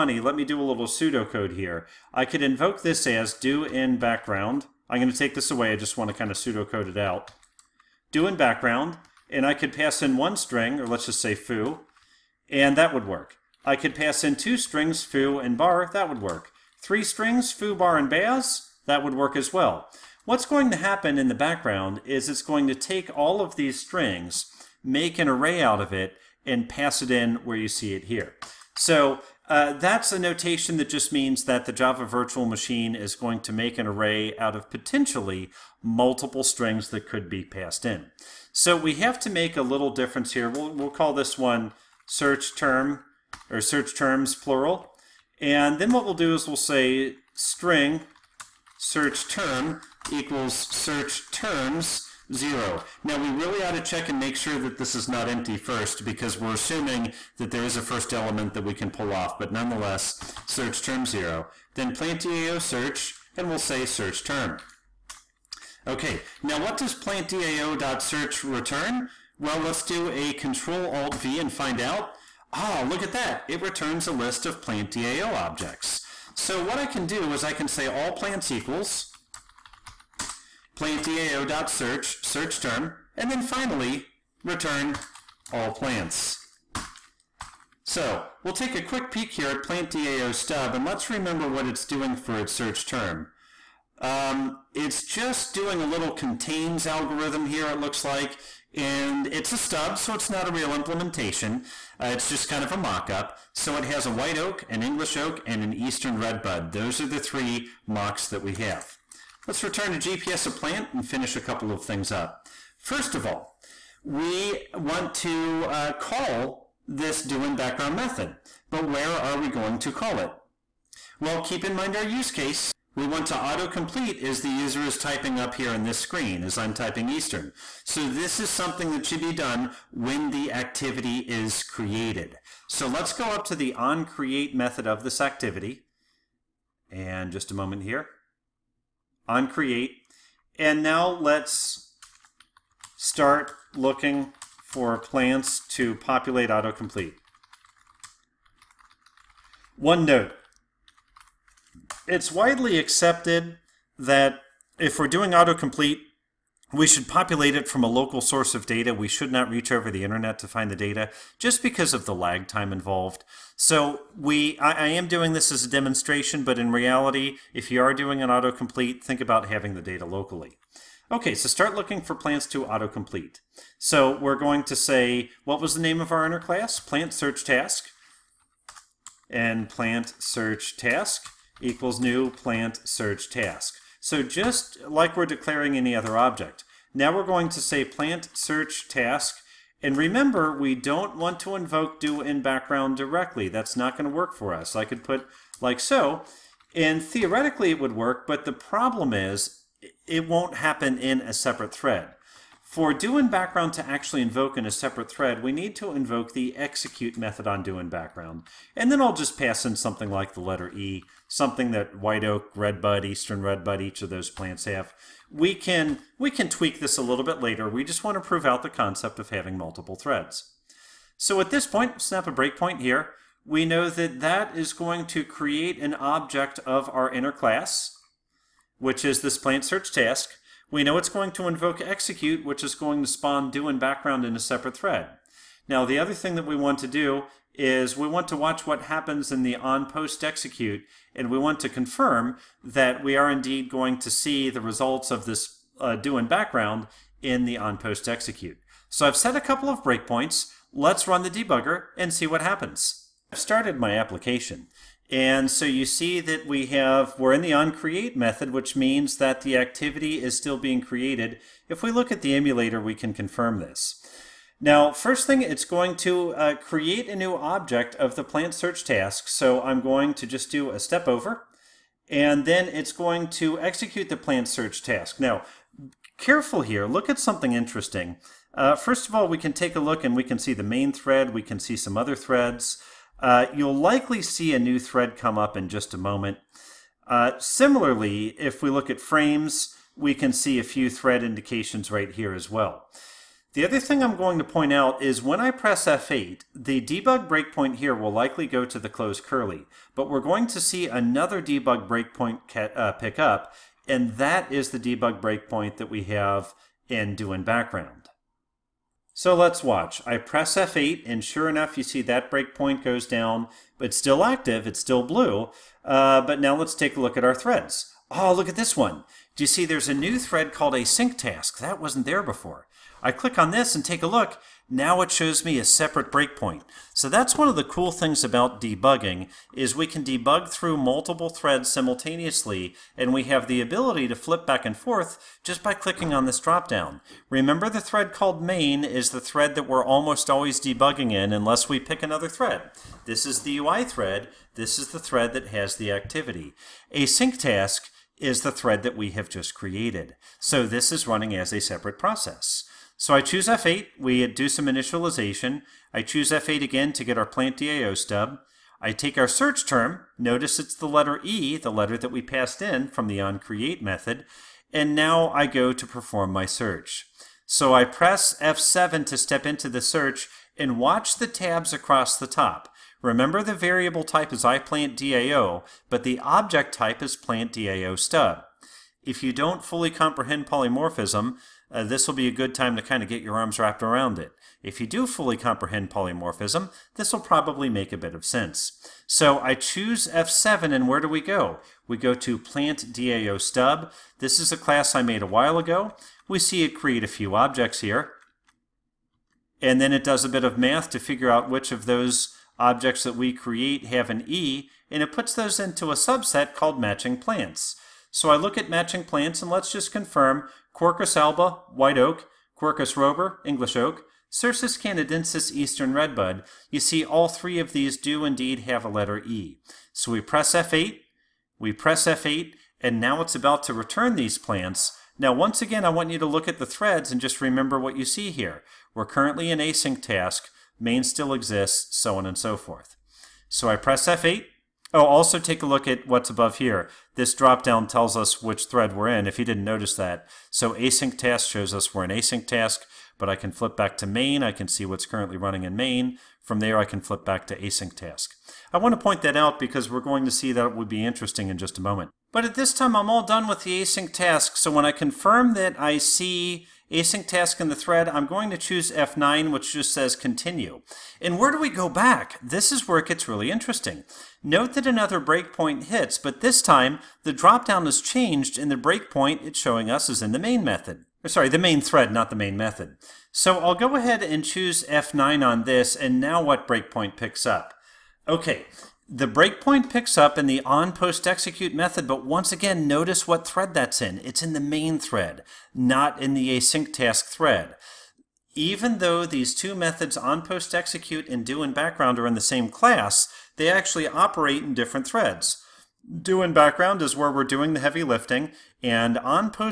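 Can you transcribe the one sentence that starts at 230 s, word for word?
We know it's going to invoke execute, which is going to spawn do in background in a separate thread.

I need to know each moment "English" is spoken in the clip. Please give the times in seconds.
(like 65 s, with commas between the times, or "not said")
104 s, 413 s.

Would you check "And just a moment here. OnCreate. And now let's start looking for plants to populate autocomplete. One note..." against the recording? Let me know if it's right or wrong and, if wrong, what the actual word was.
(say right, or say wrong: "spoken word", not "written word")
right.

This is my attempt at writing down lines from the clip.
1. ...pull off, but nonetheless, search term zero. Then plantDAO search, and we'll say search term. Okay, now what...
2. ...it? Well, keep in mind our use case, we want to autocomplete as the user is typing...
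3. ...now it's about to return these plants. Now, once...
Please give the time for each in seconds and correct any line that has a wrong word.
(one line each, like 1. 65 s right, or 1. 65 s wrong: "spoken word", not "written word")
1. 58 s right
2. 120 s right
3. 422 s right.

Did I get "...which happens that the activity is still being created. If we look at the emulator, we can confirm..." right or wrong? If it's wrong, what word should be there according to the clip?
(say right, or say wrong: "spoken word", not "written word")
wrong: "means", not "happens".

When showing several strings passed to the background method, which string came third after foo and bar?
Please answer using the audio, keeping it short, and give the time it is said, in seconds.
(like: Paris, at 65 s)
bass, at 18 s.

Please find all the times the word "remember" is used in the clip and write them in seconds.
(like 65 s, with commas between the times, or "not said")
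91 s, 189 s, 337 s, 373 s, 427 s.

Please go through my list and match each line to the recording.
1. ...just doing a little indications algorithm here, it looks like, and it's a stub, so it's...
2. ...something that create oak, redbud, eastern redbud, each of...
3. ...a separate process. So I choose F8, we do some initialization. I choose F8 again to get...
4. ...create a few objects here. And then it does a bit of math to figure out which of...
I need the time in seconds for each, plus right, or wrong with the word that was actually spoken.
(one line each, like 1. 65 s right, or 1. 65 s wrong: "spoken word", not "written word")
1. 95 s wrong: "contains", not "indications"
2. 211 s wrong: "white", not "create"
3. 351 s right
4. 396 s right.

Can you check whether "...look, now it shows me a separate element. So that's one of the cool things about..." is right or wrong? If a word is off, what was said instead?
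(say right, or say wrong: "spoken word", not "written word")
wrong: "breakpoint", not "element".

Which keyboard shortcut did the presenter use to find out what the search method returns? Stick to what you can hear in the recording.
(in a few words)
Control Alt V.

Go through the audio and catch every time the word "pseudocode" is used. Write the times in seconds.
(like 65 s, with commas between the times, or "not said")
0 s, 6 s.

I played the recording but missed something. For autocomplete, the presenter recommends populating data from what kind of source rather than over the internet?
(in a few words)
local source.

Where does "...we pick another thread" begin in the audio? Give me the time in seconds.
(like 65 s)
341 s.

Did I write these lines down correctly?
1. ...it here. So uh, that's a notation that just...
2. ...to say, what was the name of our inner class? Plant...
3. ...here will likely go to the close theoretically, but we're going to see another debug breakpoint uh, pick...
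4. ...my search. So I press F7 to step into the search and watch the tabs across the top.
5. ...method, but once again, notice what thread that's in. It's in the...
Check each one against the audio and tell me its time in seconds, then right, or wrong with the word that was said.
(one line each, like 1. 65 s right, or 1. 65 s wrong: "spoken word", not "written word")
1. 27 s right
2. 174 s right
3. 297 s wrong: "curly", not "theoretically"
4. 366 s right
5. 481 s right.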